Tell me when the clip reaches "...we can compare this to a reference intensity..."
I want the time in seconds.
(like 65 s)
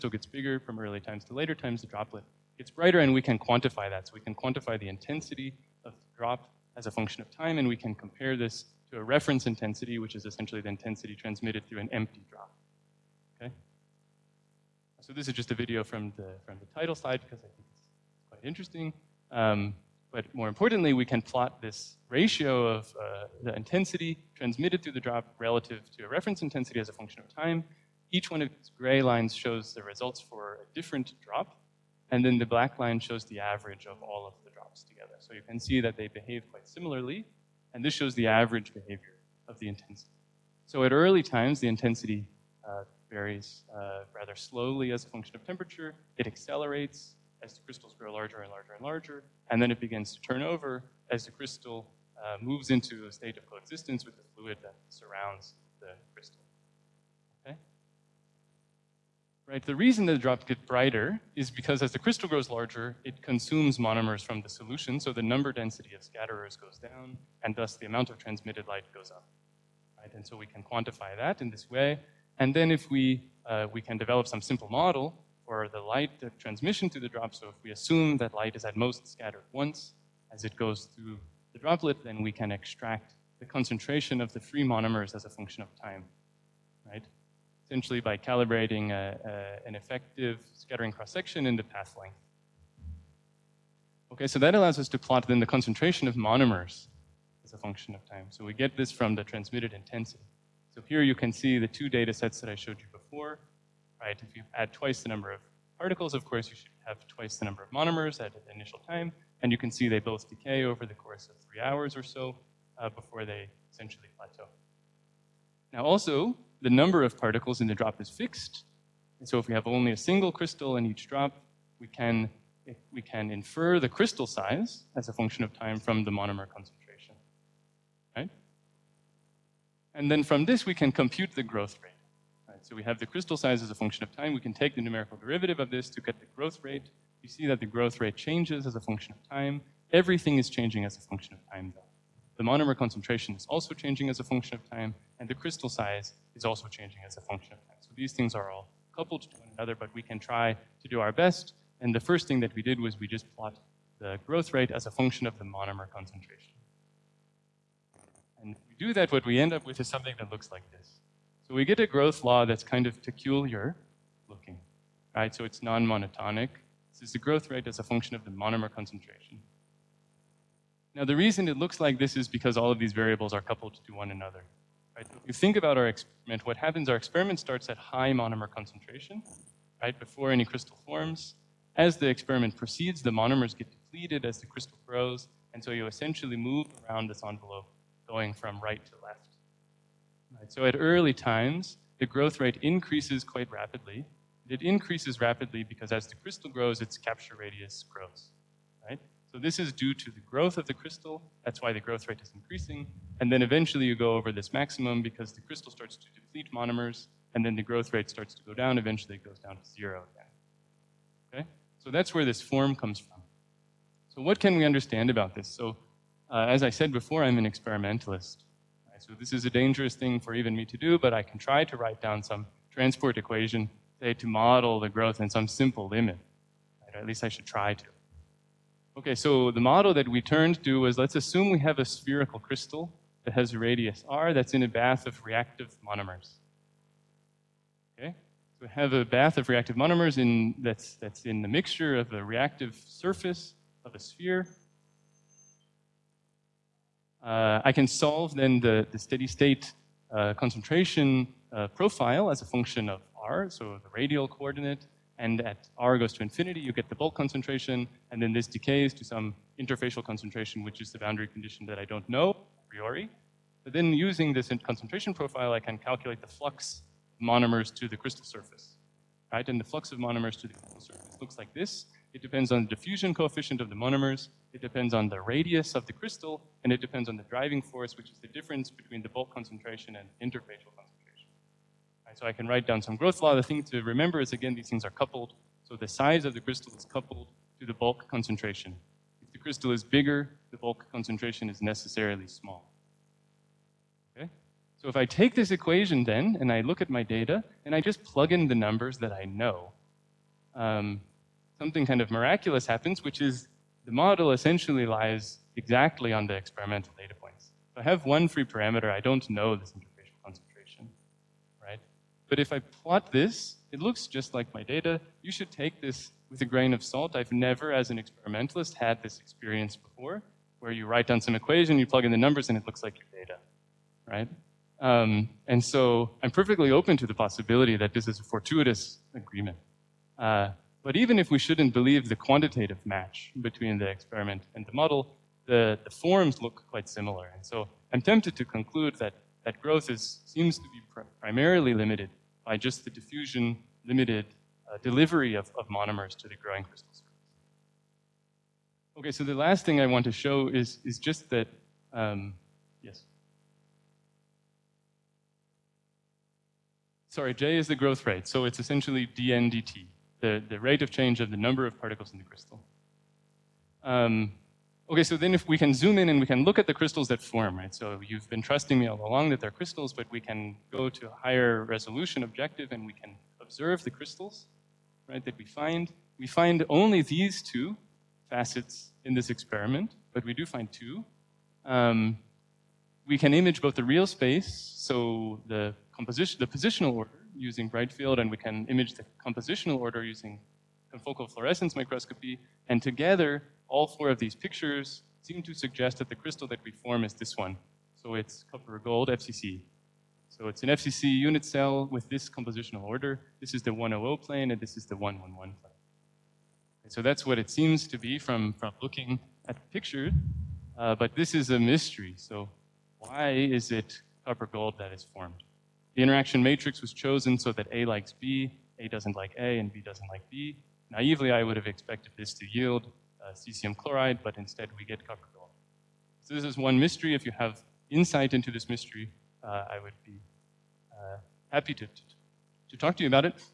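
7 s.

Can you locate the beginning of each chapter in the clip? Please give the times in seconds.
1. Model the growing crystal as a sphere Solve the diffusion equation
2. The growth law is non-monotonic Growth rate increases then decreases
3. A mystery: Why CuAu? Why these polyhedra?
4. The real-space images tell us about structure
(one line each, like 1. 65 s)
1. 214 s
2. 150 s
3. 409 s
4. 348 s.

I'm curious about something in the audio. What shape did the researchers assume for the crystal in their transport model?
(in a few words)
Spherical.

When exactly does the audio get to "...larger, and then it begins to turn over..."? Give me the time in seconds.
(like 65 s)
48 s.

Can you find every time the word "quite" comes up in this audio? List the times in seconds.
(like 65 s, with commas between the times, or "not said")
18 s, 36 s, 193 s, 336 s.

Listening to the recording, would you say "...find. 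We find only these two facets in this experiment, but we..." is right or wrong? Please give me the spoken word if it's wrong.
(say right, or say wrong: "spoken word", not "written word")
right.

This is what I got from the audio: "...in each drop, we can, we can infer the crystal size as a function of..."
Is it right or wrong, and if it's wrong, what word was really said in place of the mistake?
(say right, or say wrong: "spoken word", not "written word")
right.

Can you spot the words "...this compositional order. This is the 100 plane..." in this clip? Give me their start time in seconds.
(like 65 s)
402 s.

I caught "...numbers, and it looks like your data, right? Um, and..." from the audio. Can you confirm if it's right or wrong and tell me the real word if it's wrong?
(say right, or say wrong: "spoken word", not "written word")
right.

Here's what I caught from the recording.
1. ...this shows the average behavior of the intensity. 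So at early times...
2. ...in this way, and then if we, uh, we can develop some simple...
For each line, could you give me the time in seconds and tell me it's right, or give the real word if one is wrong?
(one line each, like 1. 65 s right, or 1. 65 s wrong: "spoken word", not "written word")
1. 37 s right
2. 71 s right.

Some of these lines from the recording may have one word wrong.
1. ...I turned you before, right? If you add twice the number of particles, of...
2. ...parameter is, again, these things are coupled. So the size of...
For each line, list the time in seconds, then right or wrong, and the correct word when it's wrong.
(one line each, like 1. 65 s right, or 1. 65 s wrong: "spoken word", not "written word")
1. 102 s wrong: "showed", not "turned"
2. 283 s wrong: "remember", not "parameter".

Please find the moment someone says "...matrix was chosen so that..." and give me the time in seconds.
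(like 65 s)
416 s.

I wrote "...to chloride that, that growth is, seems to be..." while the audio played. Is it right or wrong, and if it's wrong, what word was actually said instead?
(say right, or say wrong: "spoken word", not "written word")
wrong: "conclude", not "chloride".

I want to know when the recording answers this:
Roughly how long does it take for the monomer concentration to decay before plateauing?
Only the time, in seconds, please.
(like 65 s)
111 s.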